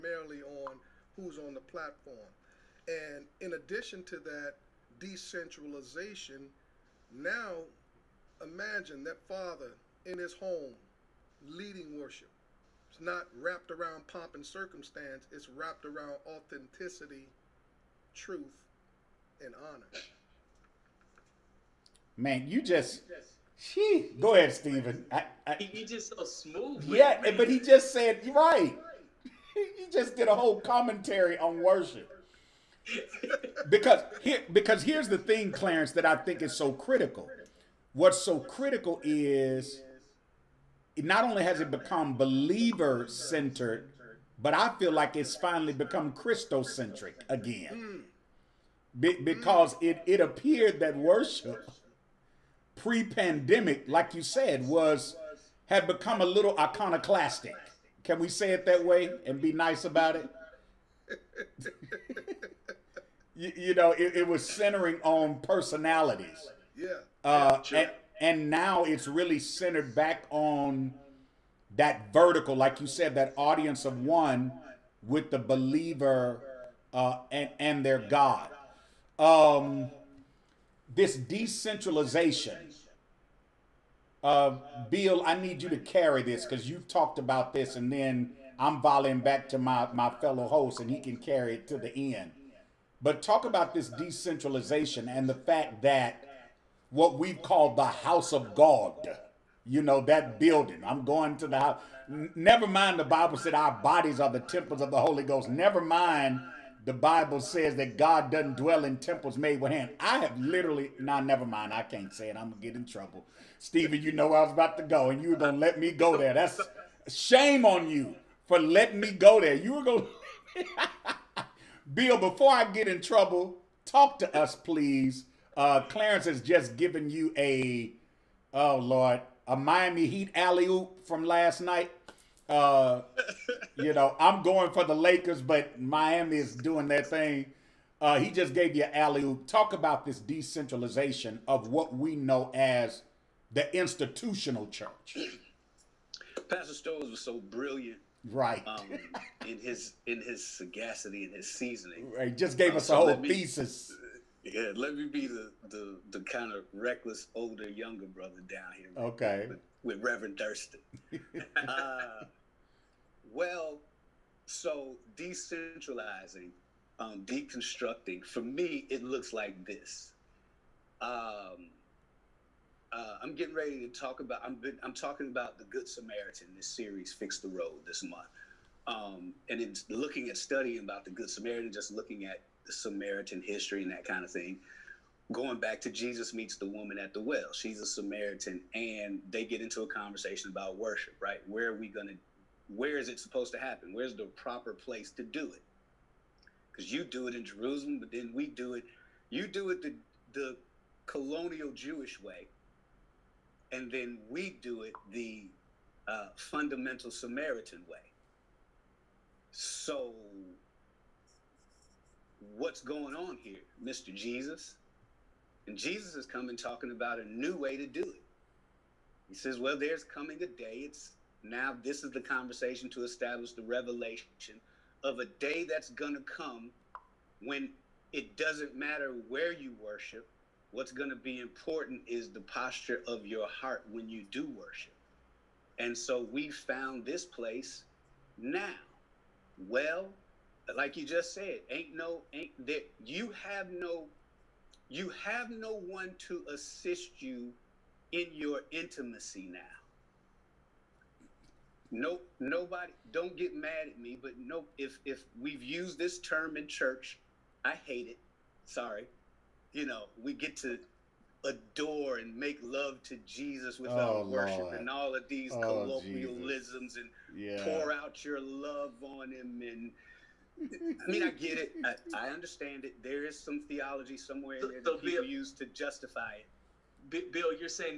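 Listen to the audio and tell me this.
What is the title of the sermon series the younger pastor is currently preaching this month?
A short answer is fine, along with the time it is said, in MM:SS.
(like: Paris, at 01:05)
Fix the Road, at 02:57.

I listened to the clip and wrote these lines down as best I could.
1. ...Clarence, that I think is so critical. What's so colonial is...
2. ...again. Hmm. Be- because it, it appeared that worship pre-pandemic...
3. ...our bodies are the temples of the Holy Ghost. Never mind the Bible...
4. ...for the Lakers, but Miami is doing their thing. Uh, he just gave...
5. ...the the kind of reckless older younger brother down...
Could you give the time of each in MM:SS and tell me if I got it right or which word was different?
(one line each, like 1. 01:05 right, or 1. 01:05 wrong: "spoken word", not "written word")
1. 00:35 wrong: "critical", not "colonial"
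2. 00:47 right
3. 01:43 right
4. 02:14 right
5. 02:35 right.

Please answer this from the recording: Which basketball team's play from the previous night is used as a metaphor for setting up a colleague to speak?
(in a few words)
Miami Heat.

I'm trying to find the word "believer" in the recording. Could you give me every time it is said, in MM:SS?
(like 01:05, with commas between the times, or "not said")
00:42, 01:15.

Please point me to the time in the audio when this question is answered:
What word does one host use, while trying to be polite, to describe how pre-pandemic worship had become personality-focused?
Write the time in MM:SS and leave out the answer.
00:56.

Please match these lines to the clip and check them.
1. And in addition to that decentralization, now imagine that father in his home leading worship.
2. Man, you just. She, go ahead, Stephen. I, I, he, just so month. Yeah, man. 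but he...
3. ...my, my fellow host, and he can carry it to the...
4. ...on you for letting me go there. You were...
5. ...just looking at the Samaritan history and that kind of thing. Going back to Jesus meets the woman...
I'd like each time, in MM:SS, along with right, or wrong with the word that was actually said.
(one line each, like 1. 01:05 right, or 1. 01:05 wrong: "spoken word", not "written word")
1. 00:02 right
2. 00:22 wrong: "smooth", not "month"
3. 01:29 right
4. 01:57 right
5. 03:01 right.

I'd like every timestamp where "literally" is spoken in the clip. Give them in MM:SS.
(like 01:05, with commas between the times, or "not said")
01:50.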